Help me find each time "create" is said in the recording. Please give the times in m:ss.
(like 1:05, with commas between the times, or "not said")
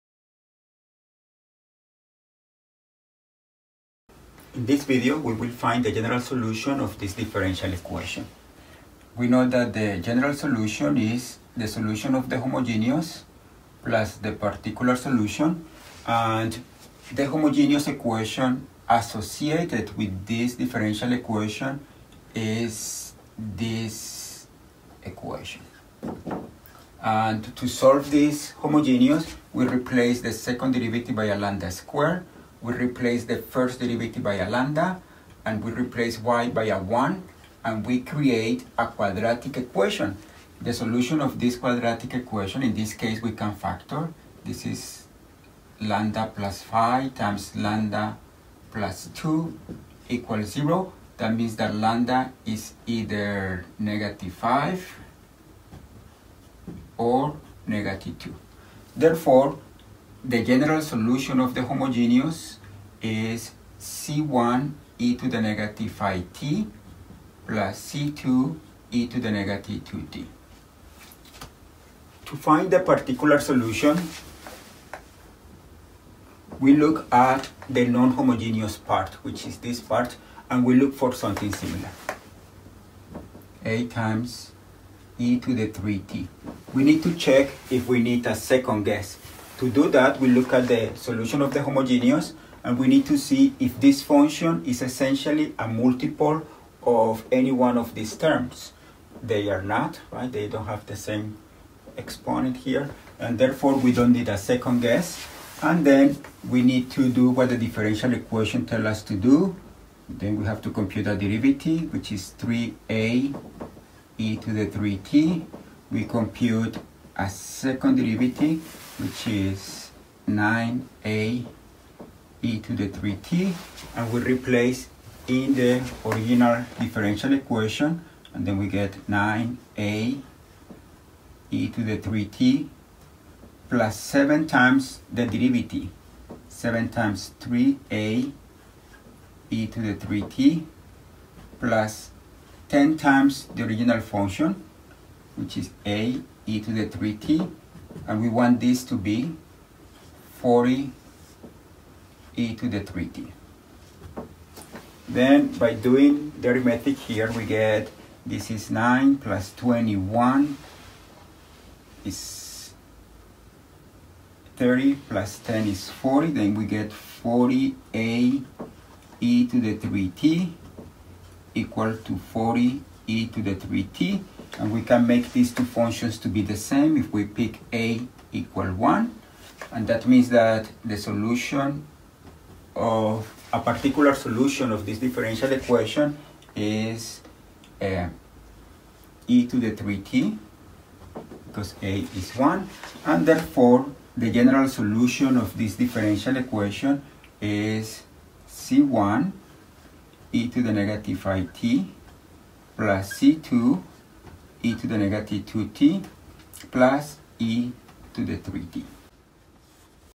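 0:38.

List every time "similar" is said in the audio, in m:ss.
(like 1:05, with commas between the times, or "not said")
1:21.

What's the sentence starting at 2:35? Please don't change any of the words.
Then by doing the arithmetic here, we get this is 9 plus 21 is 30 plus 10 is 40.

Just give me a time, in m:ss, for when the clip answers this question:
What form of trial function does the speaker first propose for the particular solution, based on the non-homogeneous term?
1:23.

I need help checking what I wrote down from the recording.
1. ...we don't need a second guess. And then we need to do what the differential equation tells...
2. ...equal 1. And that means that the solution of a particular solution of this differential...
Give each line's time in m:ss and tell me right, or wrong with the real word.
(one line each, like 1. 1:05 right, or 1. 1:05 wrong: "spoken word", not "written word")
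1. 1:43 right
2. 2:58 right.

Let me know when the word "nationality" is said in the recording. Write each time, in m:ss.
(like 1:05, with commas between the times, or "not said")
not said.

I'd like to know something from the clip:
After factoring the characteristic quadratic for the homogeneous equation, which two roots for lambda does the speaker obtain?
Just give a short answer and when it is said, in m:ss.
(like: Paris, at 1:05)
-5 or -2, at 0:53.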